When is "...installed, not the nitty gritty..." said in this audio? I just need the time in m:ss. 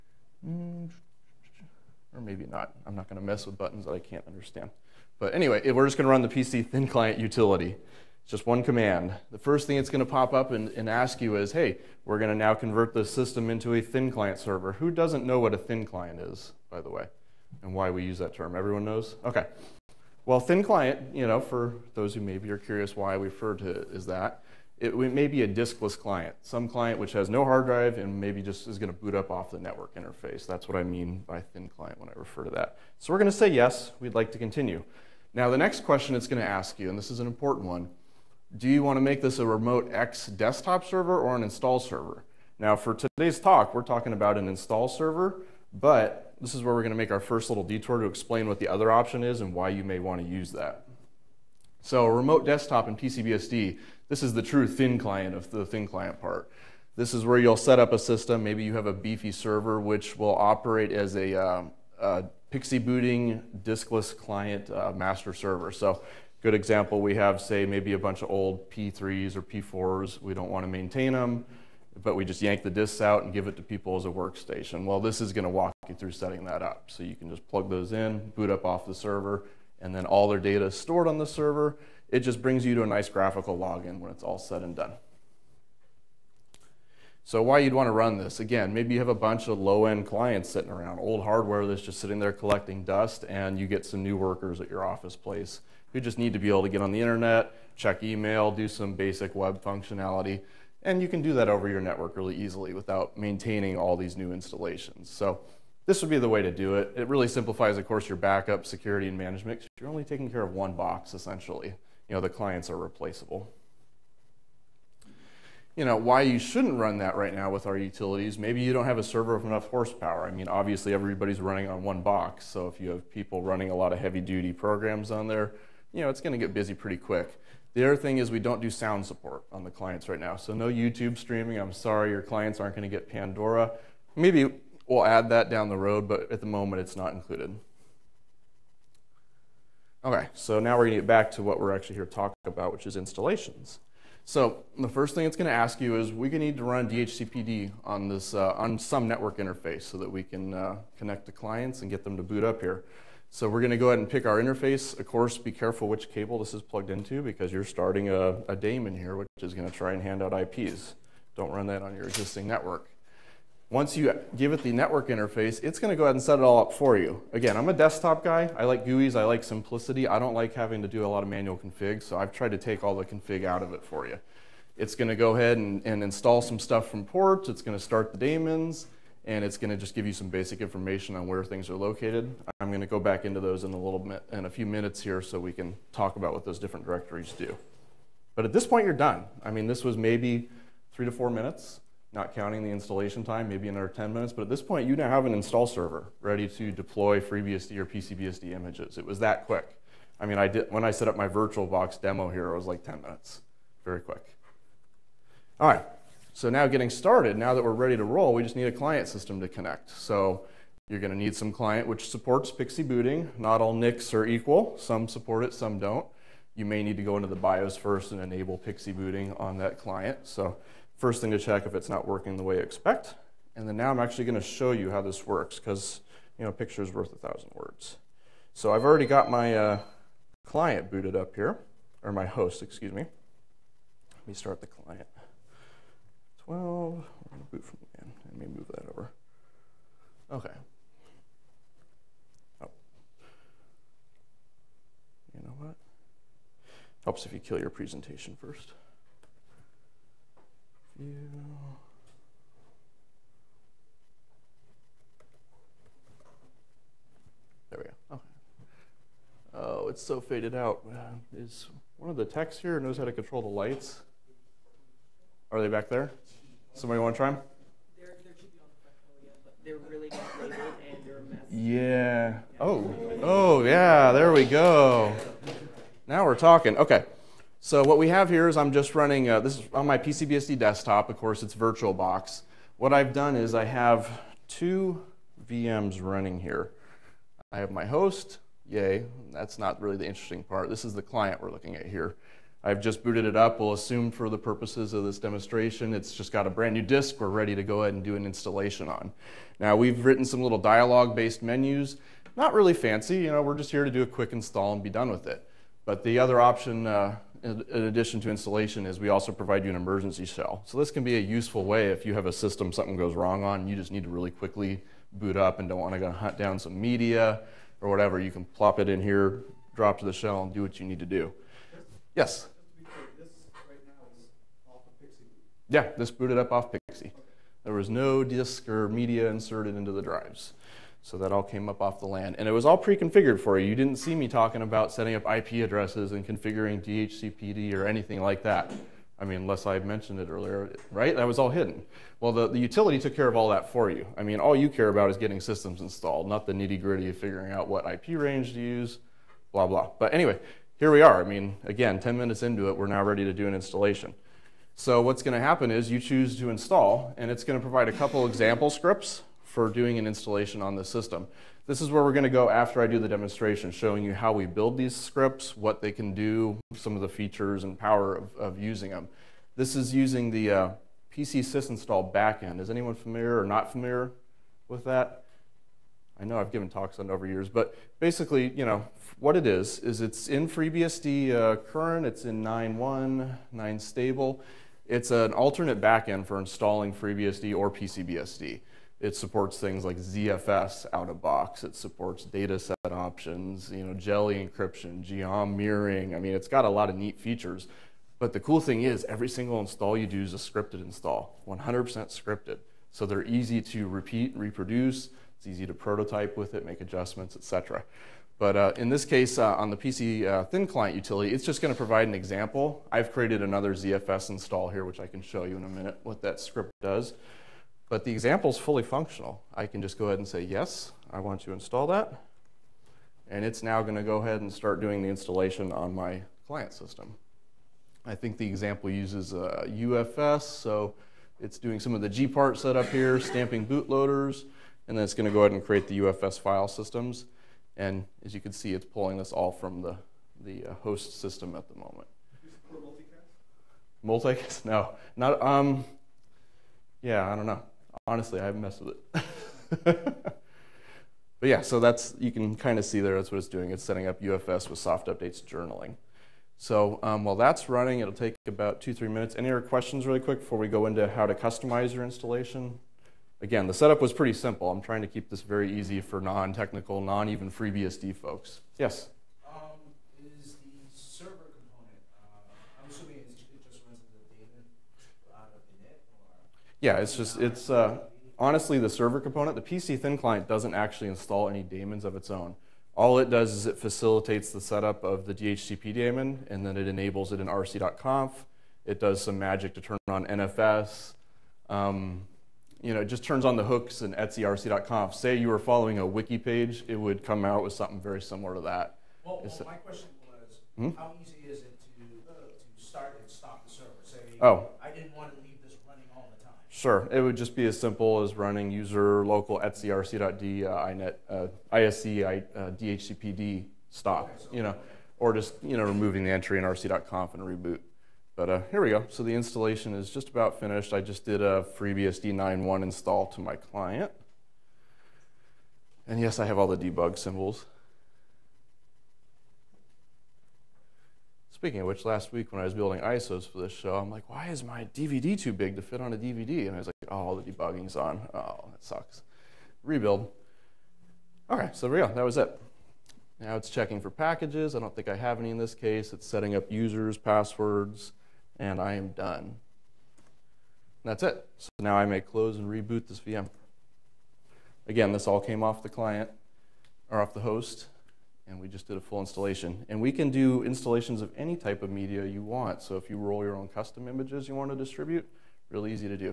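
5:45.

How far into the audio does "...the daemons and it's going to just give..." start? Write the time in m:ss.
2:58.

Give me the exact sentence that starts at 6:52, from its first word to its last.
I've created another ZFS install here, which I can show you in a minute what that script does.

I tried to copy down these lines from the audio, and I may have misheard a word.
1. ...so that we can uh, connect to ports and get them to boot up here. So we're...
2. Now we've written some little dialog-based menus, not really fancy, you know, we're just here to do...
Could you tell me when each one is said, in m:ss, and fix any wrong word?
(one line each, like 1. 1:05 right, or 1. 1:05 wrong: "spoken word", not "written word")
1. 2:29 wrong: "clients", not "ports"
2. 4:59 right.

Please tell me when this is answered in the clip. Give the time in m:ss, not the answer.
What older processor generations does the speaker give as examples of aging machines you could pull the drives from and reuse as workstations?
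1:08.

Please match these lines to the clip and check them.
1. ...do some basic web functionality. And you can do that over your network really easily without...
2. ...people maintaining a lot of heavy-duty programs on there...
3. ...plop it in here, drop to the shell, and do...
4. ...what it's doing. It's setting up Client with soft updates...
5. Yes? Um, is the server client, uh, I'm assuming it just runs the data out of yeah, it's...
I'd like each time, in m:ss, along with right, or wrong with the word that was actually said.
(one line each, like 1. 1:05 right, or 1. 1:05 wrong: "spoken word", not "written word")
1. 1:38 right
2. 2:03 wrong: "running", not "maintaining"
3. 5:18 right
4. 7:33 wrong: "UFS", not "Client"
5. 7:48 wrong: "component", not "client".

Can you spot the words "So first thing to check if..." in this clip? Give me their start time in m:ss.
3:40.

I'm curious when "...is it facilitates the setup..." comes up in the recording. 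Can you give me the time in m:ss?
8:03.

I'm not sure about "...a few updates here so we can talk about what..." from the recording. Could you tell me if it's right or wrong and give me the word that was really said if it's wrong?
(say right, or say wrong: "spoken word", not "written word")
wrong: "minutes", not "updates".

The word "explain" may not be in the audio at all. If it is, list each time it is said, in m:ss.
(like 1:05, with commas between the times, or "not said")
0:48.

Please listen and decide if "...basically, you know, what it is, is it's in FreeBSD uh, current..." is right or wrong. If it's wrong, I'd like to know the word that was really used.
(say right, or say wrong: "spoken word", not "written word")
right.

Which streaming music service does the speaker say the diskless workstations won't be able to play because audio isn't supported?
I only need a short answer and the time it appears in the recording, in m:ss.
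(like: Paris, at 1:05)
Pandora, at 2:13.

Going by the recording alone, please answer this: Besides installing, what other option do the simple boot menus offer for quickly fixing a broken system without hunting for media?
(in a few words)
emergency shell.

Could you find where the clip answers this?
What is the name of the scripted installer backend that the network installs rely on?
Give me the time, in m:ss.
6:11.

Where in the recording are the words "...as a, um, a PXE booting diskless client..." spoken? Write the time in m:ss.
1:00.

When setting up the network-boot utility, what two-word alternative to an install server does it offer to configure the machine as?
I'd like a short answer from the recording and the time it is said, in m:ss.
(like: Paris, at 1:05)
remote X desktop server, at 0:39.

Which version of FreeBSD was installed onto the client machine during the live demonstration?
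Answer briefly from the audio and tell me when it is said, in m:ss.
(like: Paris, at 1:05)
FreeBSD 9.1, at 8:41.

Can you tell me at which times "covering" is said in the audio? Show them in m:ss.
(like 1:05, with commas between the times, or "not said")
not said.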